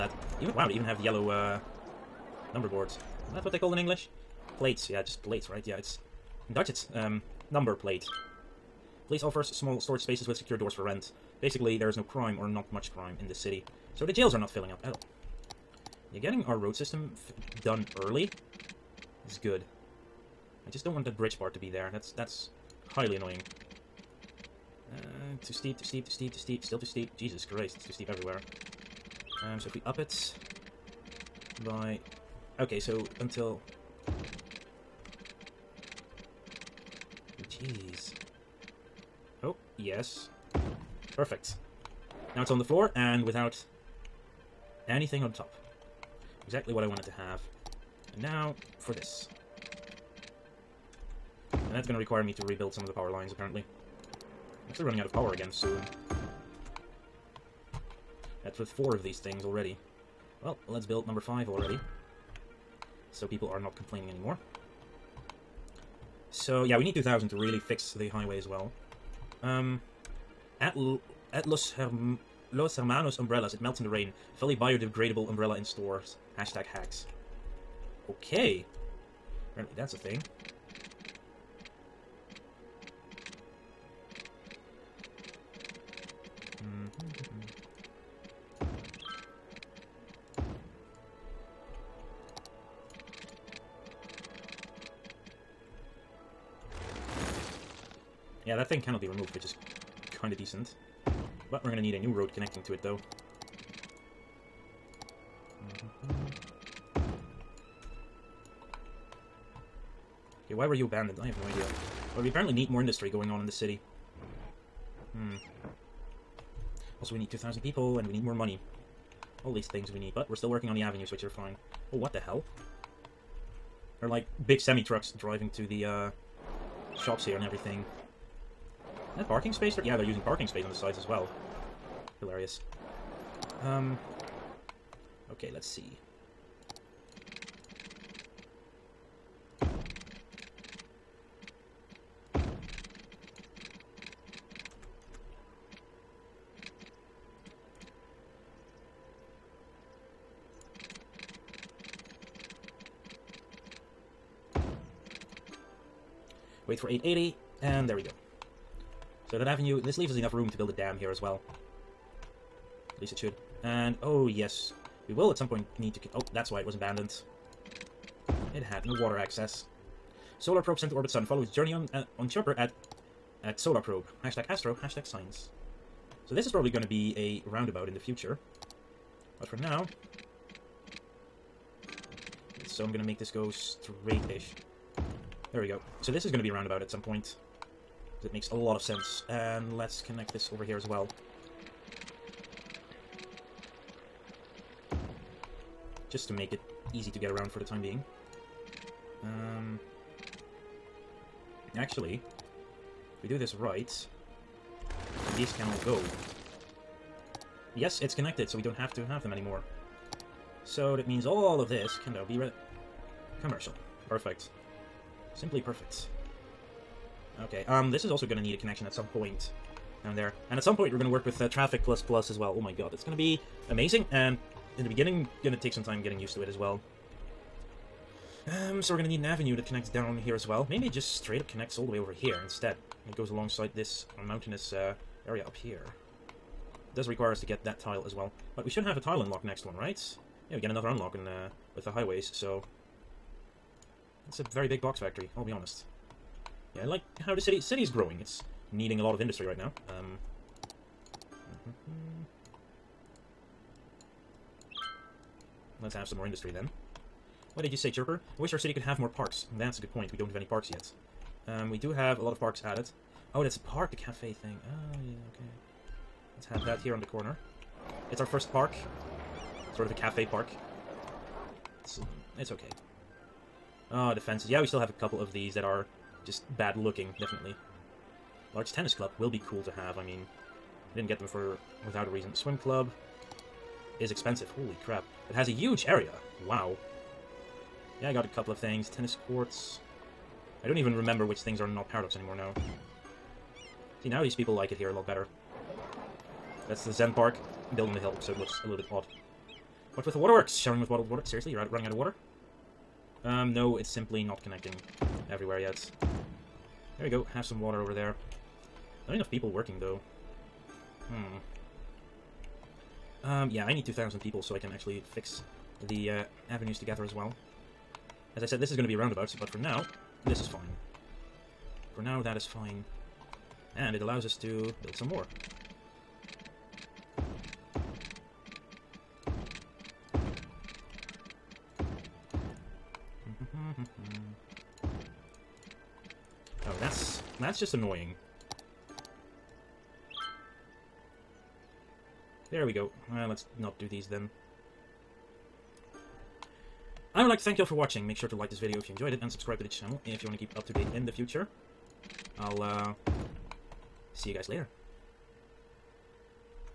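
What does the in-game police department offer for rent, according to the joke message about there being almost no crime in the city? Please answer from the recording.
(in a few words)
small storage spaces.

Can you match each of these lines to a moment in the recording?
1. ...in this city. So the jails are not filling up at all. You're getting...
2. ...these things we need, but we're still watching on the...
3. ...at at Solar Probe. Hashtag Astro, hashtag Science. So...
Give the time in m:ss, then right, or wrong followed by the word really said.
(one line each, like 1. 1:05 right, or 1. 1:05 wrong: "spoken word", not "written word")
1. 0:13 right
2. 1:59 wrong: "working", not "watching"
3. 2:52 right.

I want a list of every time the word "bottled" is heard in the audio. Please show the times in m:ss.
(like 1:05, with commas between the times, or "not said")
5:00.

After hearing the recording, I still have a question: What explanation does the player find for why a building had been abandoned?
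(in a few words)
no water access.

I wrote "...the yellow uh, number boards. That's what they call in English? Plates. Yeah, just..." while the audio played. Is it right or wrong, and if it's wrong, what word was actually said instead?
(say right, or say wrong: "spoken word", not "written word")
right.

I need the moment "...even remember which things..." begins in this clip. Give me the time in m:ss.
4:50.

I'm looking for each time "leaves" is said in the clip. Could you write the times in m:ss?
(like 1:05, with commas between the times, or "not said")
2:39.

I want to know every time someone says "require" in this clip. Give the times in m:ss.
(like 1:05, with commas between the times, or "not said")
0:51, 3:57.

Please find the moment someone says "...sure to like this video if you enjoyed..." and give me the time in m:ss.
5:48.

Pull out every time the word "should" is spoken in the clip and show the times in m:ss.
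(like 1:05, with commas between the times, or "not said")
2:43, 3:58.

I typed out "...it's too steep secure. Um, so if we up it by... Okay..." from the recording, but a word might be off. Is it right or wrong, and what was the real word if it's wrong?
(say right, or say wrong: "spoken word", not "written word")
wrong: "everywhere", not "secure".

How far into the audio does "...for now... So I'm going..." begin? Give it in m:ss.
2:59.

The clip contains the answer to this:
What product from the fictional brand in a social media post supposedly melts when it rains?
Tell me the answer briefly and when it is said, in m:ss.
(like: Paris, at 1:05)
umbrella, at 1:14.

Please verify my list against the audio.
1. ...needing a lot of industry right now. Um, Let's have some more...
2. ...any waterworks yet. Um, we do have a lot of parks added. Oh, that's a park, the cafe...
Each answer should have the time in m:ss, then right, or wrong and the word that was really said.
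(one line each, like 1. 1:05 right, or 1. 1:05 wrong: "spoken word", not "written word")
1. 4:08 right
2. 4:20 wrong: "parks", not "waterworks".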